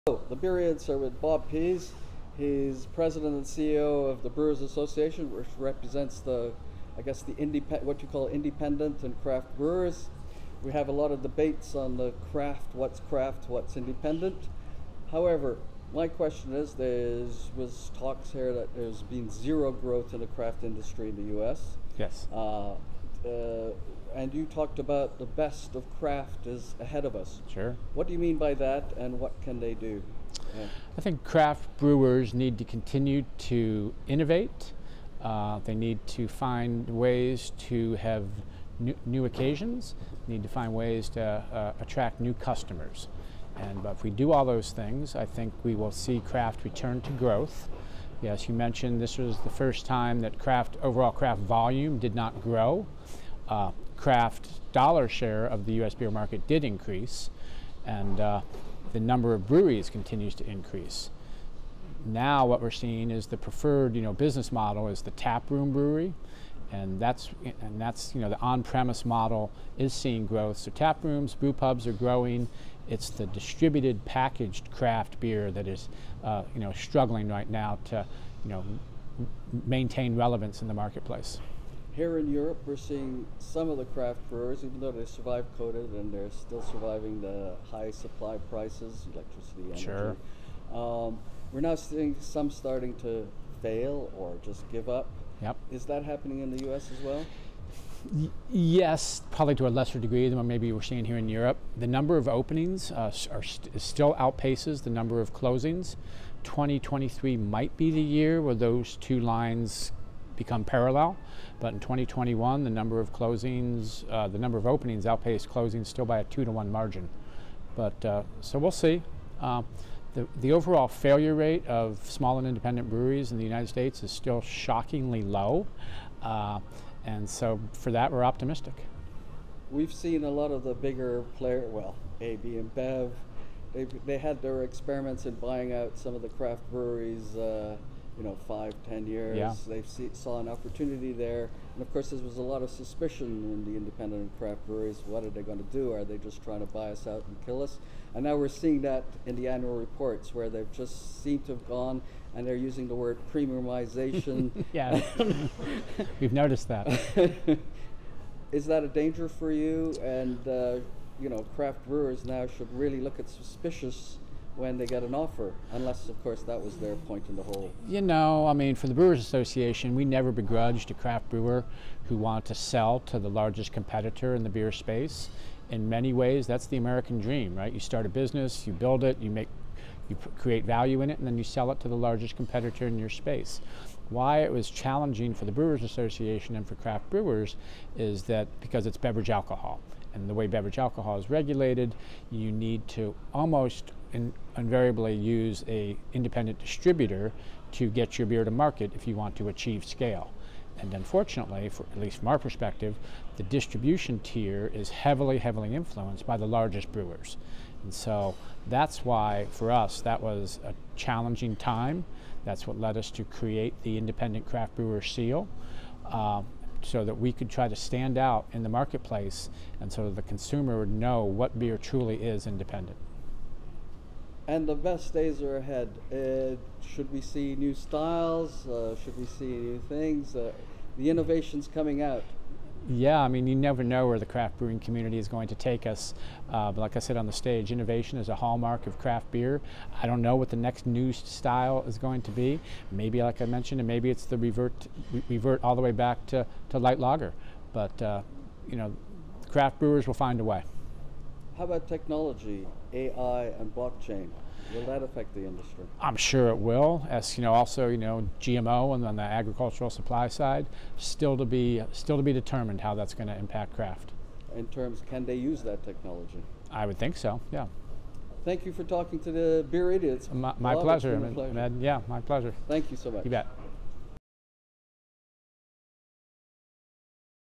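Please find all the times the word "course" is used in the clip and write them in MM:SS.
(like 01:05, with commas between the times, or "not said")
02:21, 02:46.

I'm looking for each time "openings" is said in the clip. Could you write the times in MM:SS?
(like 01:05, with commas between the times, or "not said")
01:42, 01:54.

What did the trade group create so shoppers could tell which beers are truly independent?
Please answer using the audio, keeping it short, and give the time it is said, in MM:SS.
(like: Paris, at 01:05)
Independent craft brewer seal, at 03:33.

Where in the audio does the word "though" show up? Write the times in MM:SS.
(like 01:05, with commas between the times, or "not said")
01:24.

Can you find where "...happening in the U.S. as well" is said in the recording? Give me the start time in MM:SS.
01:36.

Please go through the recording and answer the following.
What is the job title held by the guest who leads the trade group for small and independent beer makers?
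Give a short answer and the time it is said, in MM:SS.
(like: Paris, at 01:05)
President and CEO, at 00:02.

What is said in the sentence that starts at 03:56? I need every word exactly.
Uh, but like I said on the stage, innovation is a hallmark of craft beer.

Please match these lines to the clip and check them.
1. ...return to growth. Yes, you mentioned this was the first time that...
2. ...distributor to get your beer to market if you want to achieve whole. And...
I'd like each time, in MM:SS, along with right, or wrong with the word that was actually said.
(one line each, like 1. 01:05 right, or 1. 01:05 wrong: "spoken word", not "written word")
1. 00:46 right
2. 03:16 wrong: "scale", not "whole".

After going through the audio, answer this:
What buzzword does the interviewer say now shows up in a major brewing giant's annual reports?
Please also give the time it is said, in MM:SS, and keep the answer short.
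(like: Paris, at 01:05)
Premiumization, at 02:33.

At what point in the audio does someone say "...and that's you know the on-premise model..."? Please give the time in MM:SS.
01:07.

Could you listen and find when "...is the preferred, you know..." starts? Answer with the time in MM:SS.
01:03.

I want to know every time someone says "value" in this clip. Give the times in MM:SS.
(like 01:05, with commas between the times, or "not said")
03:00.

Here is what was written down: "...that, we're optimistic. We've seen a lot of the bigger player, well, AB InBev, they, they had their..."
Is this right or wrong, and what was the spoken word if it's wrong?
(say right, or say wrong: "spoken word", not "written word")
right.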